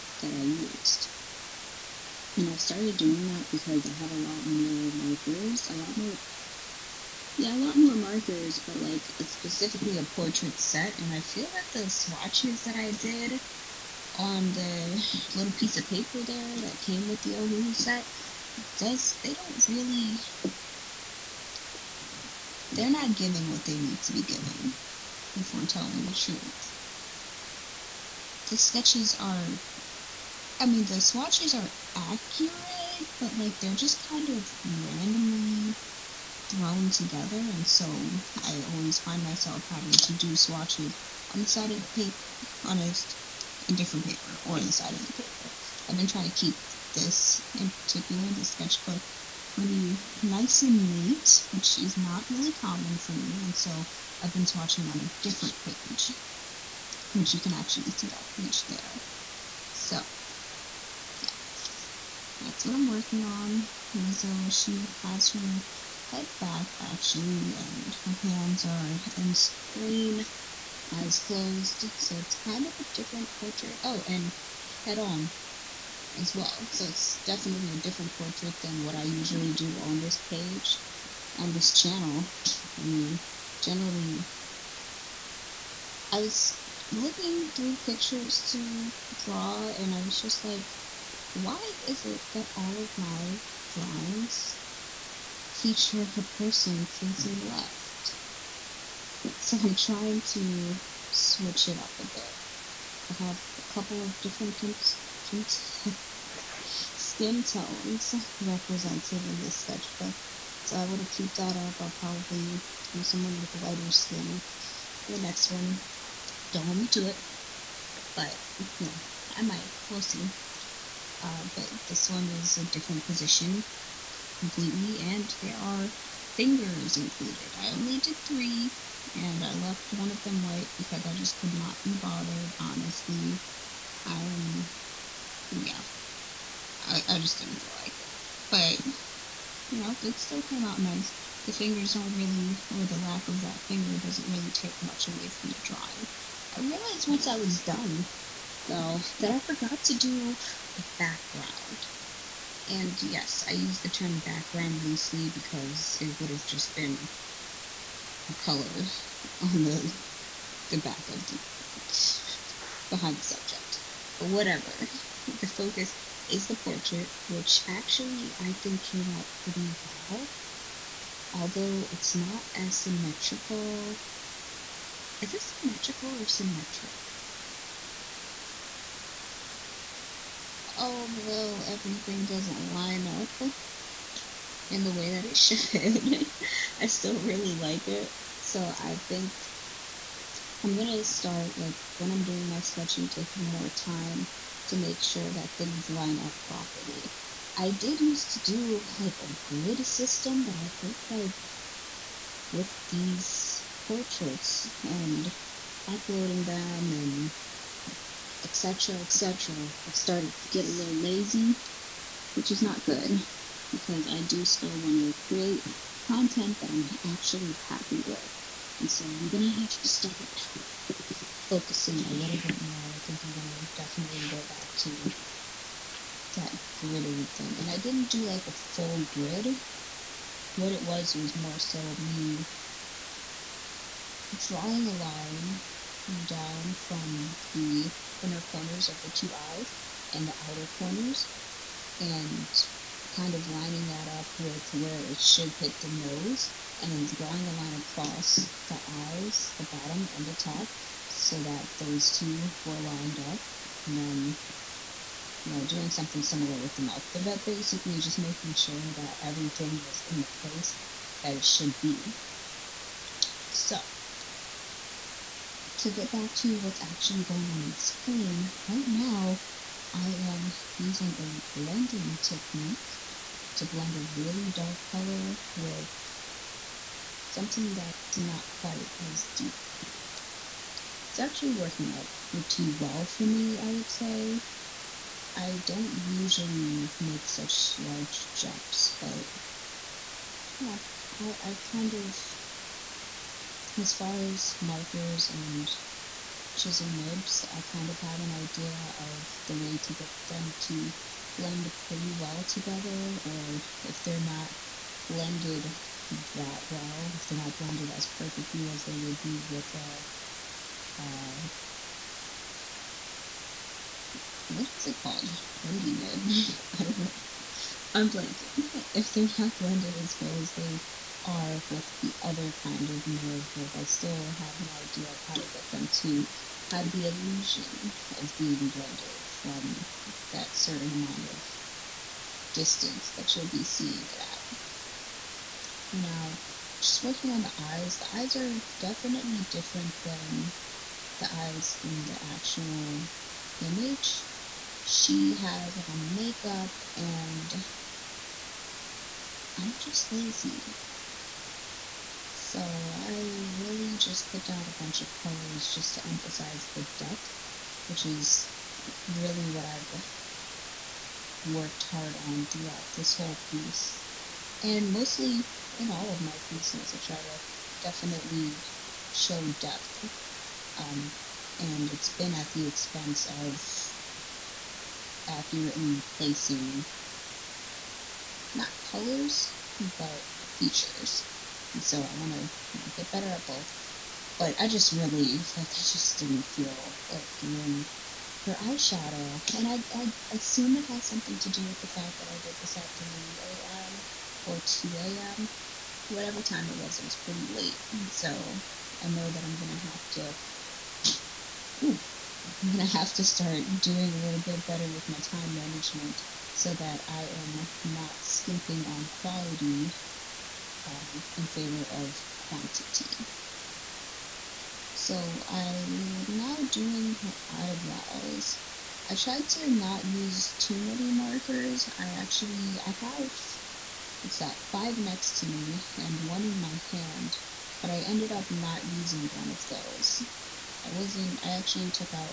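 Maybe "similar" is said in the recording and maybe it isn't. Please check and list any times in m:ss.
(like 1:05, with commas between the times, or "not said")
4:16.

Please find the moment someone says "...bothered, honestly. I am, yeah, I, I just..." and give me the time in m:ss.
2:11.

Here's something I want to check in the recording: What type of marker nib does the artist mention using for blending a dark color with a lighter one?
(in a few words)
Chisel nibs.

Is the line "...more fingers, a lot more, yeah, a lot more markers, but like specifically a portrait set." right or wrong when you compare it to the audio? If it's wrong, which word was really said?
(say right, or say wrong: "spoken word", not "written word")
wrong: "markers", not "fingers".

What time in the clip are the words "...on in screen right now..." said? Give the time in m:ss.
4:27.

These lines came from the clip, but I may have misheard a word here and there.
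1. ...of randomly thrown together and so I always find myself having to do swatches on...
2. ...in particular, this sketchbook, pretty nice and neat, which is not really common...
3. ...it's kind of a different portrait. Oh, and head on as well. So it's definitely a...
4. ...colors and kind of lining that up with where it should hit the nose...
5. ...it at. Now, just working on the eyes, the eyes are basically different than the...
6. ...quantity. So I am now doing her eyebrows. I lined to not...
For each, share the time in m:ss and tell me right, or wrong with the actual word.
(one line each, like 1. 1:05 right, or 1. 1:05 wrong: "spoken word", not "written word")
1. 0:34 right
2. 0:47 right
3. 1:12 right
4. 4:00 wrong: "corners", not "colors"
5. 5:34 wrong: "definitely", not "basically"
6. 6:52 wrong: "tried", not "lined".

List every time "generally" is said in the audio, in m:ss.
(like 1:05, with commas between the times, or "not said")
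1:23.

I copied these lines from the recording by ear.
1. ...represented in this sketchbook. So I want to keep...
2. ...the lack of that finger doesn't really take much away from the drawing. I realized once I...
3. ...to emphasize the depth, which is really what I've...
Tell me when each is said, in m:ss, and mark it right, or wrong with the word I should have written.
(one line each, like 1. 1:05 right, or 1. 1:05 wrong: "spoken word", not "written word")
1. 1:48 right
2. 2:22 right
3. 5:55 right.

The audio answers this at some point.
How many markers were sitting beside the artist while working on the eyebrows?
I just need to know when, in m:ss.
7:04.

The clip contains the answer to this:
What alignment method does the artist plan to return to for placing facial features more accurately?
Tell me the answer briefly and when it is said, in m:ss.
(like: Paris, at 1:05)
Grid system, at 3:19.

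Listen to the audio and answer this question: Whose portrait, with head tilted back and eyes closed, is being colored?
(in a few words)
Lizzo.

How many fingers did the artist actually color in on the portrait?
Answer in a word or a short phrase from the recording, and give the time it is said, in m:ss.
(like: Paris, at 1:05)
3, at 2:08.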